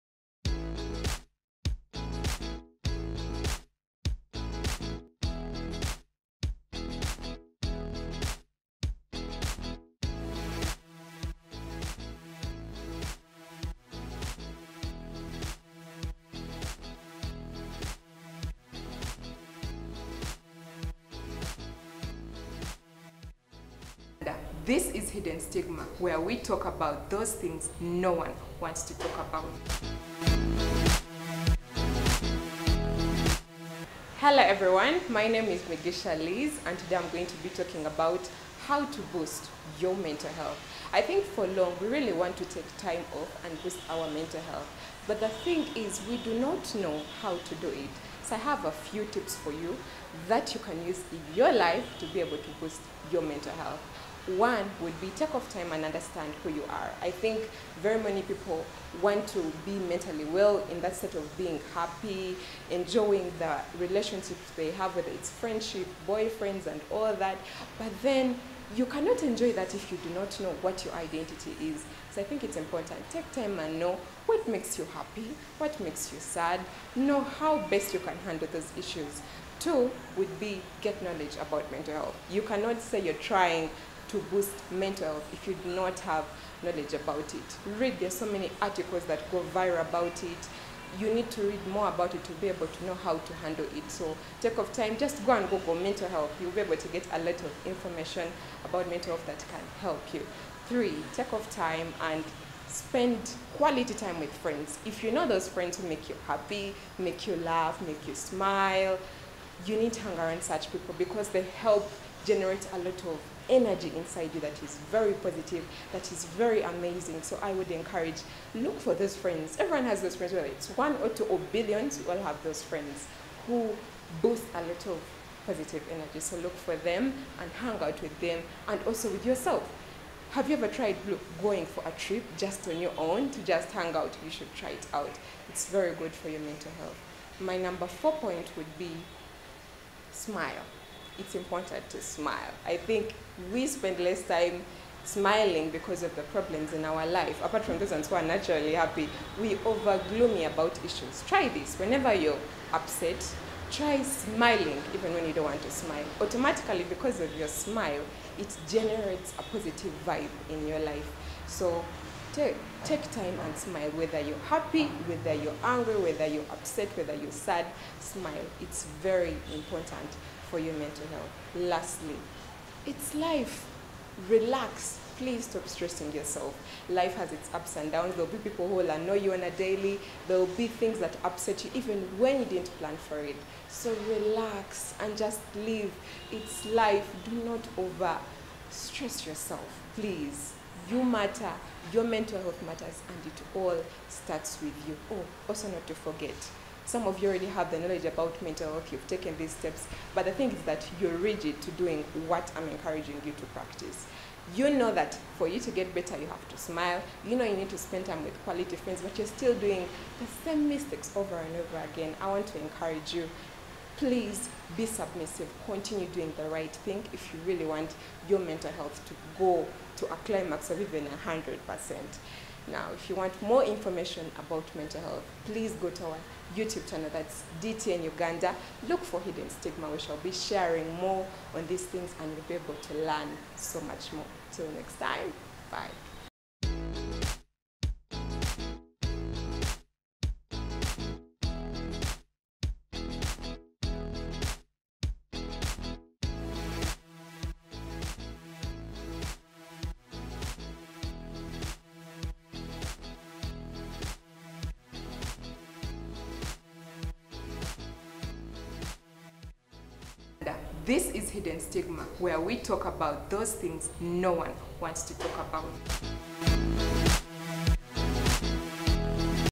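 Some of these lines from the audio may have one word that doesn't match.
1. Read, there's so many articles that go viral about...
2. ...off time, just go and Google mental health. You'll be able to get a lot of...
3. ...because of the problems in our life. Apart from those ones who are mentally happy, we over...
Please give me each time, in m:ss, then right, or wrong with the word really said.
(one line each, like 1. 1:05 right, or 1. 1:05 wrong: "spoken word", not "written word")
1. 1:27 right
2. 1:34 right
3. 2:25 wrong: "naturally", not "mentally".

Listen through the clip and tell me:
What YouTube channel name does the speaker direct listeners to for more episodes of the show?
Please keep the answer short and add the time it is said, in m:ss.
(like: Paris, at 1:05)
DTN Uganda, at 3:47.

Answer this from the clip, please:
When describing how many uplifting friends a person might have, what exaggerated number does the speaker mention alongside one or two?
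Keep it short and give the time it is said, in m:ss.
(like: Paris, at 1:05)
billions, at 2:01.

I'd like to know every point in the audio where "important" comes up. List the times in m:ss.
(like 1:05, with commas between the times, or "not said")
1:12, 2:21, 2:49.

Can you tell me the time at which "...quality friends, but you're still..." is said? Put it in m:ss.
3:28.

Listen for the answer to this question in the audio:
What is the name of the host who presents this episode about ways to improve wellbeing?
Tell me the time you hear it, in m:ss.
0:35.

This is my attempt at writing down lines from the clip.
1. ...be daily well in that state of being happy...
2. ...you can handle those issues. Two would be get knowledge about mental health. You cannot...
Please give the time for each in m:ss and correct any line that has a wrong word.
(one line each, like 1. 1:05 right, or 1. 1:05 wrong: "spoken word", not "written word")
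1. 0:59 wrong: "mentally", not "daily"
2. 1:17 right.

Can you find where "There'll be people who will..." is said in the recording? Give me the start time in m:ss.
2:58.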